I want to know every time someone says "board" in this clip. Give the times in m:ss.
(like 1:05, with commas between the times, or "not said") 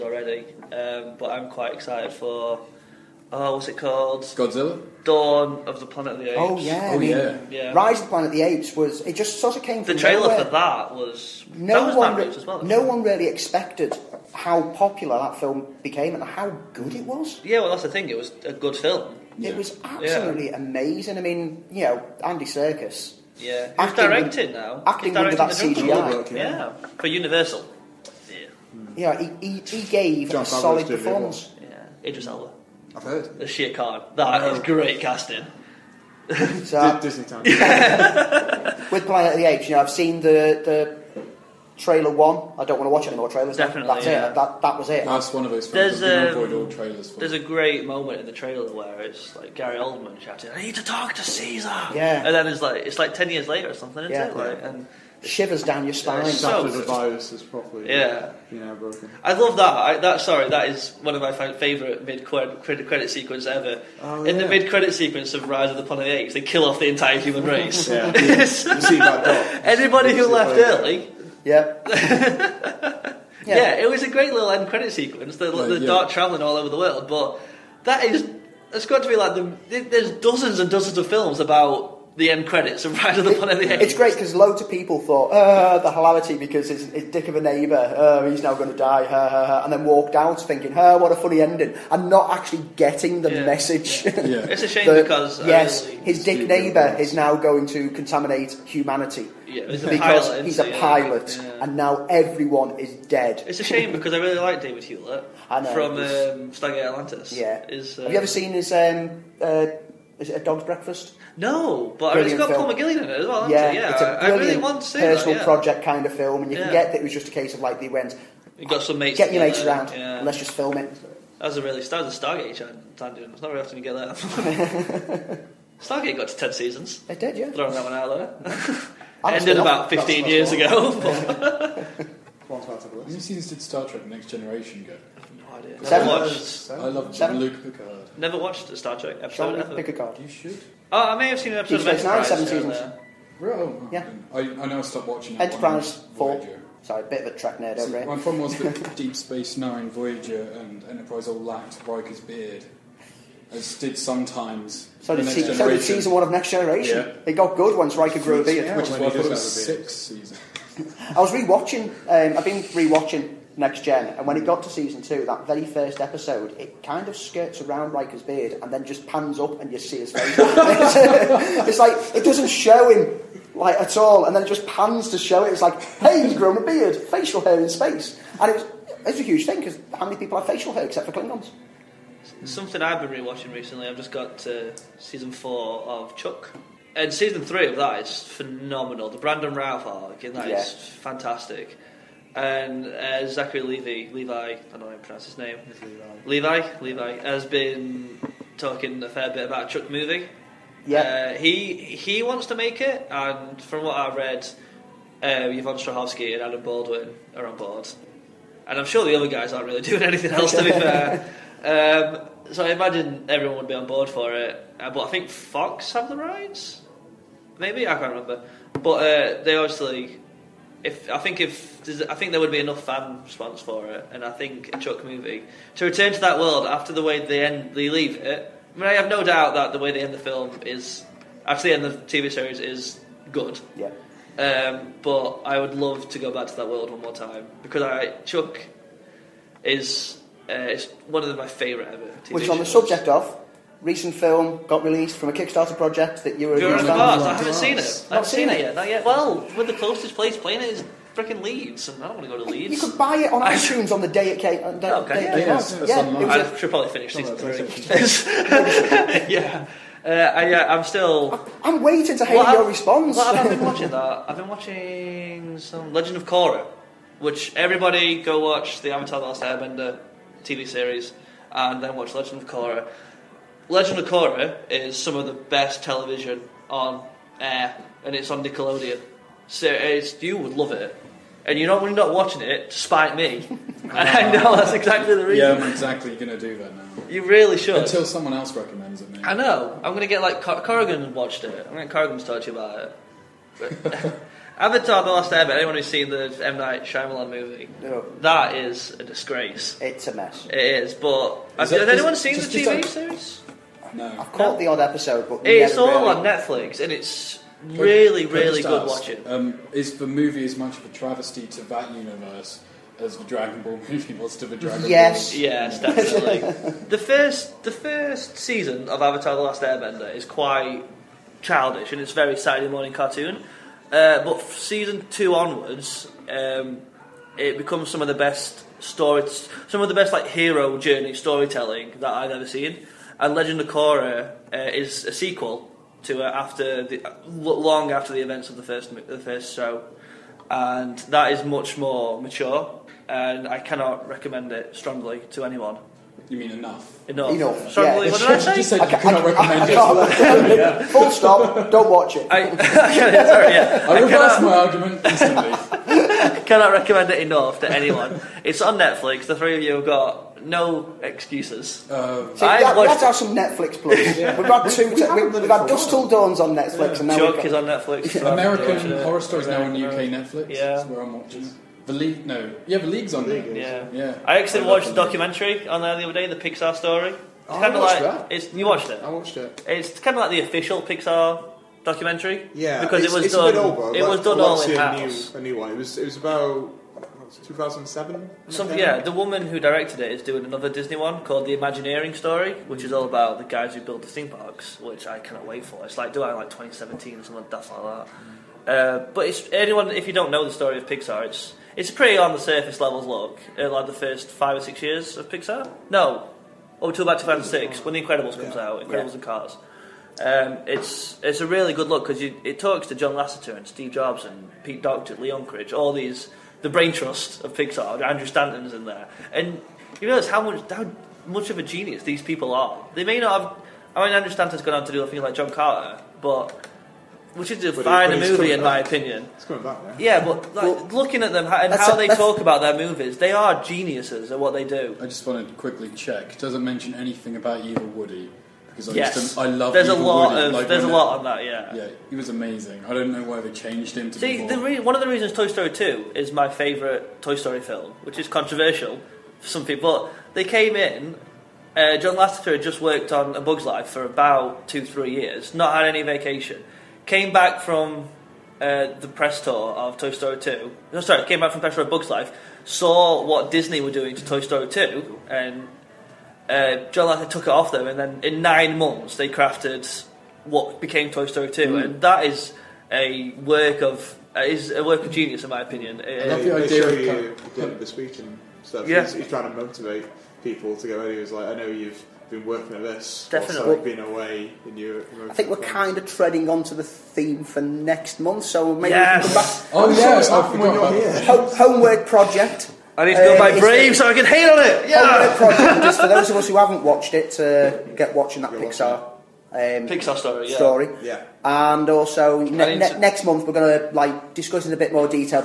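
3:27, 3:33.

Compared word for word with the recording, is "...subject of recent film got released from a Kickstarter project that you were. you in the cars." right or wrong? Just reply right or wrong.
right.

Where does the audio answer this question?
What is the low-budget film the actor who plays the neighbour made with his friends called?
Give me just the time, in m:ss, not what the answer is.
1:50.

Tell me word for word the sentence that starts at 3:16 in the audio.
Levi, Levi has been talking a fair bit about a Chuck movie.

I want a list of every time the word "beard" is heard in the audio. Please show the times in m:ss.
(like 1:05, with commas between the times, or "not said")
2:32, 2:38, 2:48, 2:56.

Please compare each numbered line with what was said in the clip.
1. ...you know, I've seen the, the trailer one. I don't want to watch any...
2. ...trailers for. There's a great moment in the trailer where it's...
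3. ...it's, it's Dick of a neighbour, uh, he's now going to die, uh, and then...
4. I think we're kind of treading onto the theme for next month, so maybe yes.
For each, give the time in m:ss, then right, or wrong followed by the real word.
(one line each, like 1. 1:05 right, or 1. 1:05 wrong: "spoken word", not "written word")
1. 0:39 right
2. 0:46 right
3. 1:26 right
4. 8:05 right.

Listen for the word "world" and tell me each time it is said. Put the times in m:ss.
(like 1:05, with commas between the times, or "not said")
1:16, 3:46, 3:56.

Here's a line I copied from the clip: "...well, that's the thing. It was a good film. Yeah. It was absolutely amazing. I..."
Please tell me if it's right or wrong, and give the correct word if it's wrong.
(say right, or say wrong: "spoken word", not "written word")
right.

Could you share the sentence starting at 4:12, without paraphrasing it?
You could buy it on iTunes on the day it came.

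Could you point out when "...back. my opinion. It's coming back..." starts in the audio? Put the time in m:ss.
7:08.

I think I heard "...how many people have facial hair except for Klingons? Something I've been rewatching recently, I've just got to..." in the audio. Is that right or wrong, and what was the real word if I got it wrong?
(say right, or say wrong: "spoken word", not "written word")
right.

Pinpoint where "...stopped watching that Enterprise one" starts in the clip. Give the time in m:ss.
2:24.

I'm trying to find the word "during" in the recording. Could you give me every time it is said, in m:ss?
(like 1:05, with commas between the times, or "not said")
not said.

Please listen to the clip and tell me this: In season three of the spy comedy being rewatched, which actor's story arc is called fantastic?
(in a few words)
Brandon Routh.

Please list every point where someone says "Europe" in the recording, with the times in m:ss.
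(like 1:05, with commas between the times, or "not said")
8:04.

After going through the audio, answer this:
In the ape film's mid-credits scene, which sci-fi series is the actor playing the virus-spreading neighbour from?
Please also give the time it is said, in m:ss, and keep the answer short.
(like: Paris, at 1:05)
Stargate Atlantis, at 1:46.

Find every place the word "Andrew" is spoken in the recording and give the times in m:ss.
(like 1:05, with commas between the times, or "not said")
6:58, 7:04.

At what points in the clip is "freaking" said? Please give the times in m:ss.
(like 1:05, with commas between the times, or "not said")
4:11.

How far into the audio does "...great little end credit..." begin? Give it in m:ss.
1:14.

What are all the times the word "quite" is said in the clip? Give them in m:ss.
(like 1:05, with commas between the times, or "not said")
0:01, 5:20.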